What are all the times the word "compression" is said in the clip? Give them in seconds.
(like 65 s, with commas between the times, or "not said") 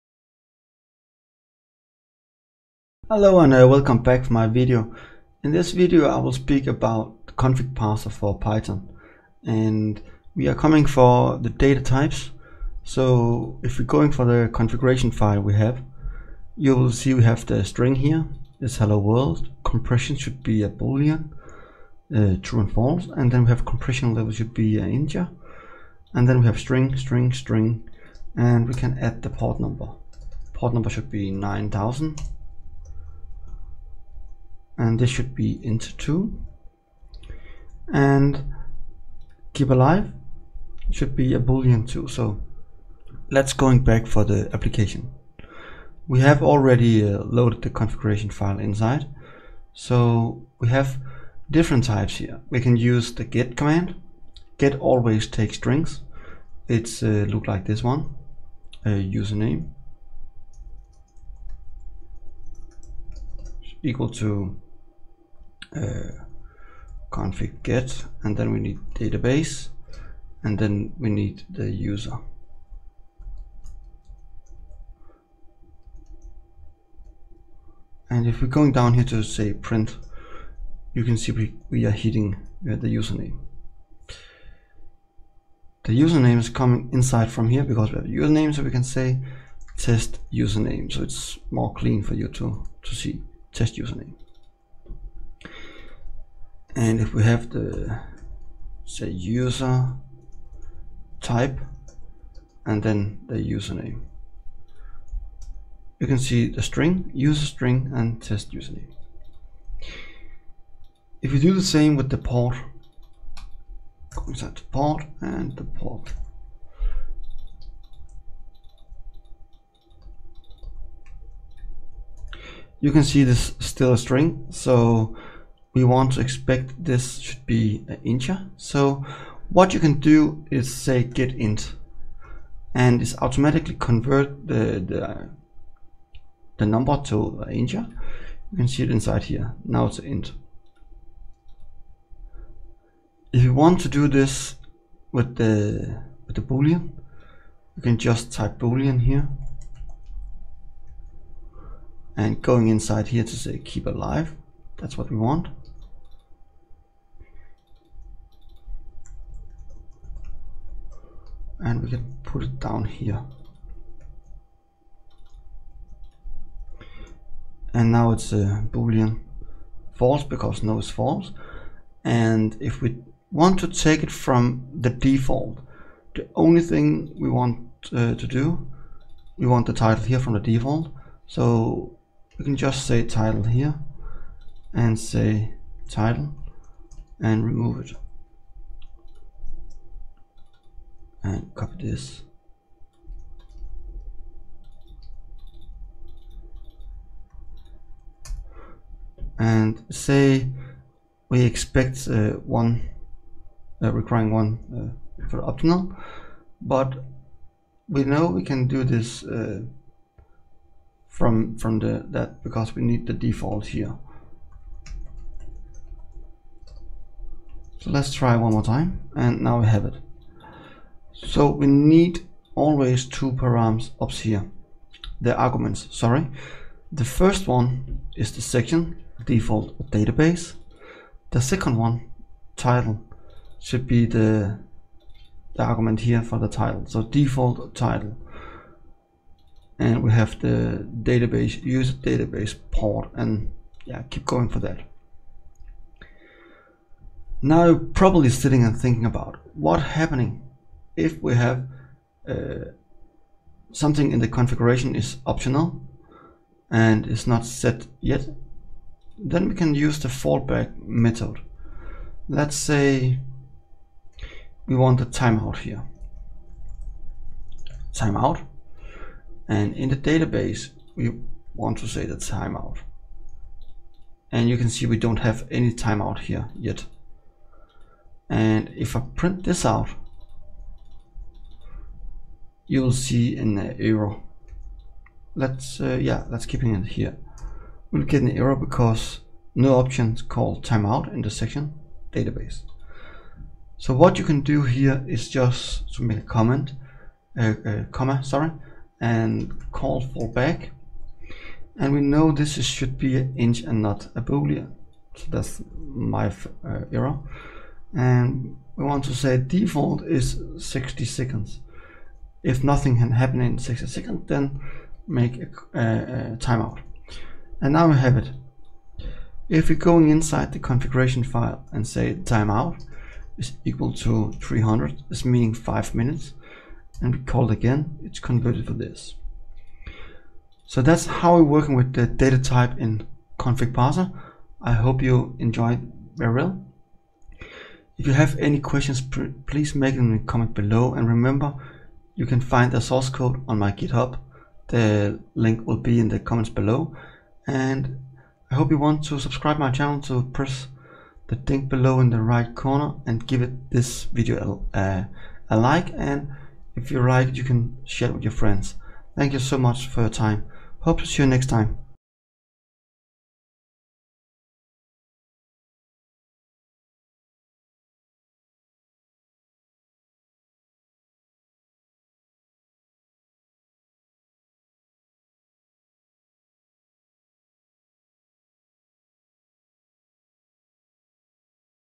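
19 s, 23 s.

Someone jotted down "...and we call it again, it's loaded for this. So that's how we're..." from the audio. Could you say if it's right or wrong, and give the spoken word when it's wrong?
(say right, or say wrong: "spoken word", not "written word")
wrong: "converted", not "loaded".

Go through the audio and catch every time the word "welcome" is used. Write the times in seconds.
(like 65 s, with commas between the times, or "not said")
3 s.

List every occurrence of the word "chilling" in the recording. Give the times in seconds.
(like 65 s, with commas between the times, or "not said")
not said.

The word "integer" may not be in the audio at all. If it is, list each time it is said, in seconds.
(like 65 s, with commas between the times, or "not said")
24 s, 128 s, 137 s.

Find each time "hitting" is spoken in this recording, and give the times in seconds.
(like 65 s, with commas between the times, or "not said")
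81 s.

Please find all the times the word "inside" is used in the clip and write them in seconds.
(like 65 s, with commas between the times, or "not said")
48 s, 86 s, 114 s, 138 s, 152 s, 320 s.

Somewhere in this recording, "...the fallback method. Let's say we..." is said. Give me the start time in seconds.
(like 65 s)
259 s.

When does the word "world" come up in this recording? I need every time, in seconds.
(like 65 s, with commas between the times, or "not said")
18 s.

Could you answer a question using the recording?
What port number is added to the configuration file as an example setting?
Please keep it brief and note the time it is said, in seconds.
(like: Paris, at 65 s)
9000, at 31 s.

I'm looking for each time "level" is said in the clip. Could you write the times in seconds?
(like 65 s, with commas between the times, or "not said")
24 s.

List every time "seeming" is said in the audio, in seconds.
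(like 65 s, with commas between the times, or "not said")
not said.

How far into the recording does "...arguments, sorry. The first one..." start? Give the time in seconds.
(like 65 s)
225 s.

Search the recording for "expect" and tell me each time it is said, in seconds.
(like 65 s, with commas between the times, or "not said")
126 s, 201 s.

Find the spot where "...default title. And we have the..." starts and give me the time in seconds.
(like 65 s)
237 s.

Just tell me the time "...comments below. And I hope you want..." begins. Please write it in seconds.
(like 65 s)
346 s.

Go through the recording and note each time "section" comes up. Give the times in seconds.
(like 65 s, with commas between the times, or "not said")
228 s, 291 s.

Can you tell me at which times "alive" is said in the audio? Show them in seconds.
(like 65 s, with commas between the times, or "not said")
39 s, 153 s.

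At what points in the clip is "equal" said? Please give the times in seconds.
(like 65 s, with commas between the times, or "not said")
63 s, 323 s.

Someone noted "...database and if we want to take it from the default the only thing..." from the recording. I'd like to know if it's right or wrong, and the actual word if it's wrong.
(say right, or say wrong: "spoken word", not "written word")
wrong: "false", not "database".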